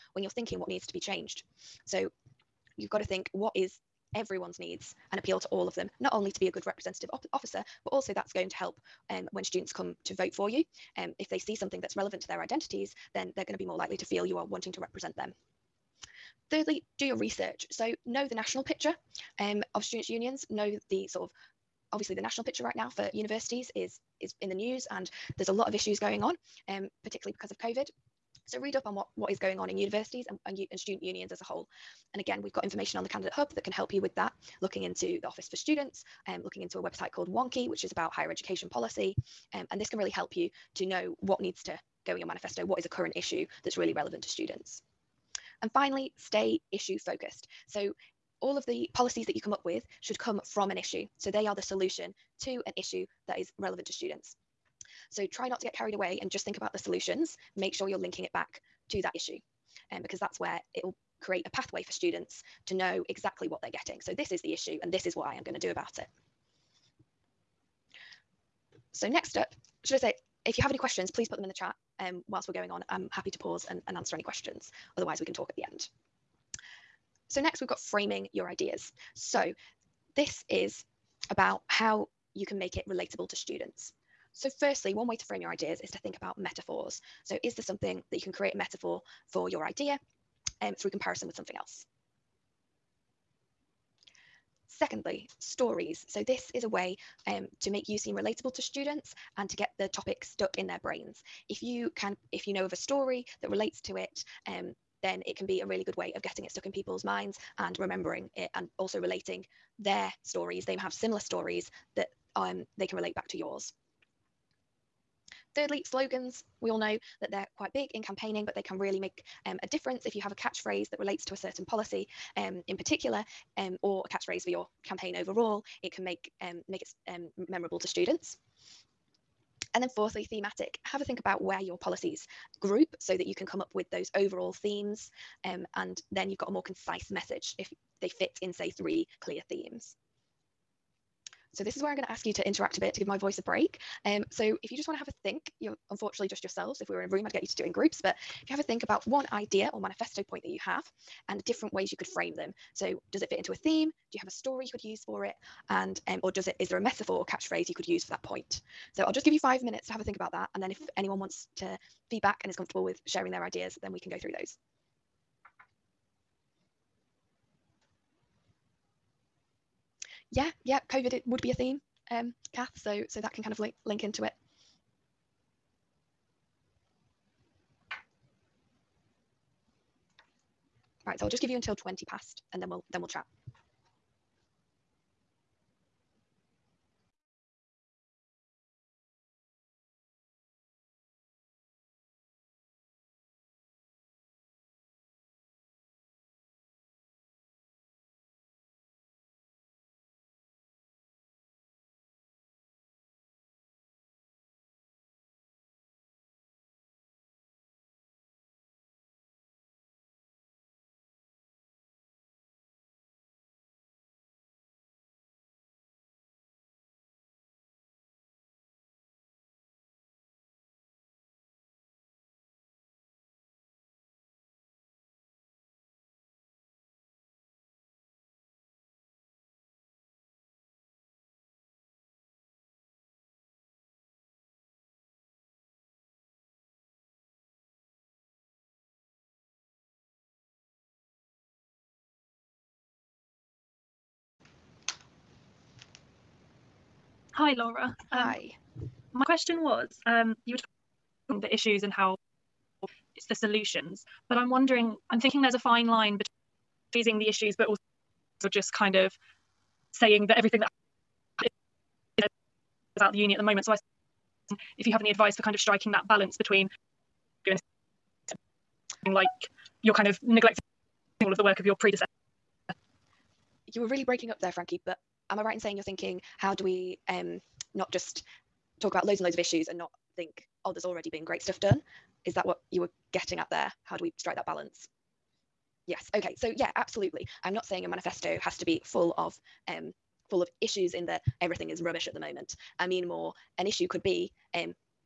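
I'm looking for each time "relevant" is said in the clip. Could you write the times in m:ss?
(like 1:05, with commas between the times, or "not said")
0:11, 0:43, 0:53.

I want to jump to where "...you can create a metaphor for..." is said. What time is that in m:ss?
1:28.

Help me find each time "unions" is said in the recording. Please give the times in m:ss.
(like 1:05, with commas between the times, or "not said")
0:20, 0:31.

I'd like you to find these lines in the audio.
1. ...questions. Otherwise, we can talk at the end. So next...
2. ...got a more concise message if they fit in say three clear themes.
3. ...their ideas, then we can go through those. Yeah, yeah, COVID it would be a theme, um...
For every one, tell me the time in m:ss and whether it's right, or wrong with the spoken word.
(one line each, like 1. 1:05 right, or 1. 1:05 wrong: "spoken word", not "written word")
1. 1:14 right
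2. 2:16 right
3. 2:43 right.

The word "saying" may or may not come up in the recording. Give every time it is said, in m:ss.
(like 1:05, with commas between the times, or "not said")
4:19, 4:35, 4:47.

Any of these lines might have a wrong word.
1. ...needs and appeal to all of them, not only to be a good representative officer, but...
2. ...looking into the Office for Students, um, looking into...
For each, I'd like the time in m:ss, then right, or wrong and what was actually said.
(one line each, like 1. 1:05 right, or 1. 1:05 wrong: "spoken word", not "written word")
1. 0:04 right
2. 0:34 right.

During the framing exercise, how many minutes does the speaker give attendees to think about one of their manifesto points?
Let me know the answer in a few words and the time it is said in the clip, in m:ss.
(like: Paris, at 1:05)
5, at 2:39.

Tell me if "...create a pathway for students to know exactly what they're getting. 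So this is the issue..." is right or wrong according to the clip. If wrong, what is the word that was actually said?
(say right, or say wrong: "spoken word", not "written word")
right.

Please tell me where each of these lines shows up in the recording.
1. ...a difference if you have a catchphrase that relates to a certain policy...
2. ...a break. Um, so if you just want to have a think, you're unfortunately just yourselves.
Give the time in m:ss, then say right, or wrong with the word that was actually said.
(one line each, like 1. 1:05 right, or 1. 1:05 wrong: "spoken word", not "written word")
1. 1:59 right
2. 2:23 right.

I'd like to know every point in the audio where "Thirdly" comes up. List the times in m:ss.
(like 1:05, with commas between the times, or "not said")
0:16, 1:55.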